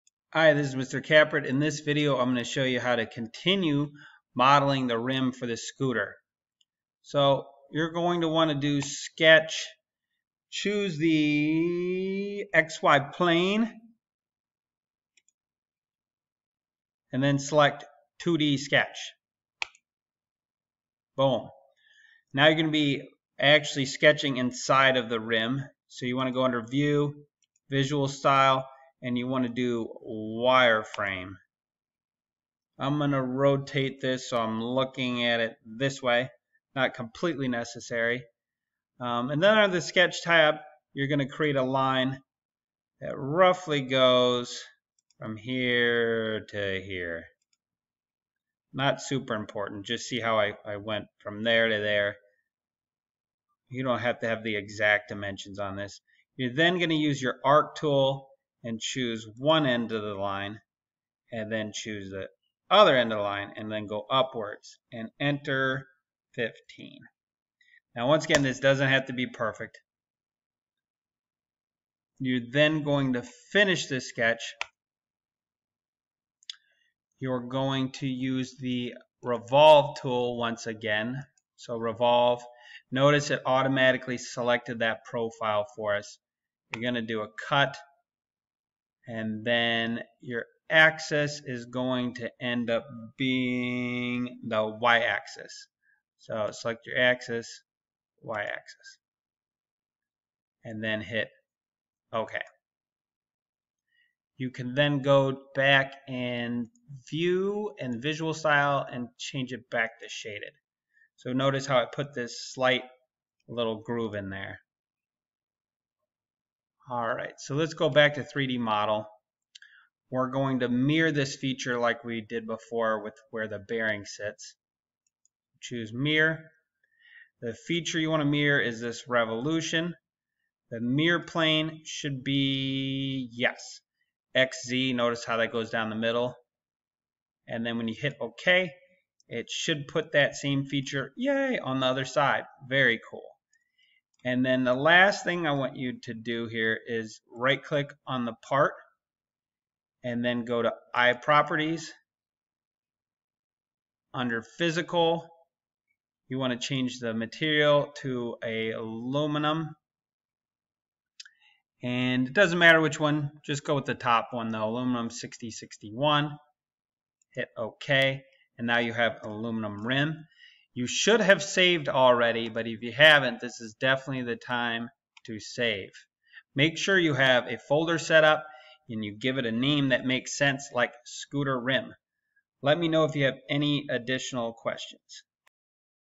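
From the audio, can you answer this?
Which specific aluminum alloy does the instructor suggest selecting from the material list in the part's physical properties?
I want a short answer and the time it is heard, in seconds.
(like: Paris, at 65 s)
aluminum 6061, at 164 s.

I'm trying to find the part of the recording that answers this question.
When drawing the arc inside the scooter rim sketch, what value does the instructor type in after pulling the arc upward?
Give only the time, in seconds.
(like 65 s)
66 s.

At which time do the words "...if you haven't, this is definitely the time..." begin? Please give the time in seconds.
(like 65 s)
172 s.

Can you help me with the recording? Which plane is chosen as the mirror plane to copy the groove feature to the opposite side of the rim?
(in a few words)
XZ.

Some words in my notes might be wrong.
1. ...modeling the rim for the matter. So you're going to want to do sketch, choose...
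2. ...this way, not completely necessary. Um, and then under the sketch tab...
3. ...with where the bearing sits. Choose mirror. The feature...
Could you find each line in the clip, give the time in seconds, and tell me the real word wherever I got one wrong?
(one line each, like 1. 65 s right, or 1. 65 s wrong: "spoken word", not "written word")
1. 4 s wrong: "scooter", not "matter"
2. 35 s right
3. 123 s right.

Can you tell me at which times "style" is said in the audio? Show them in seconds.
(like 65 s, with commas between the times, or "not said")
28 s, 108 s.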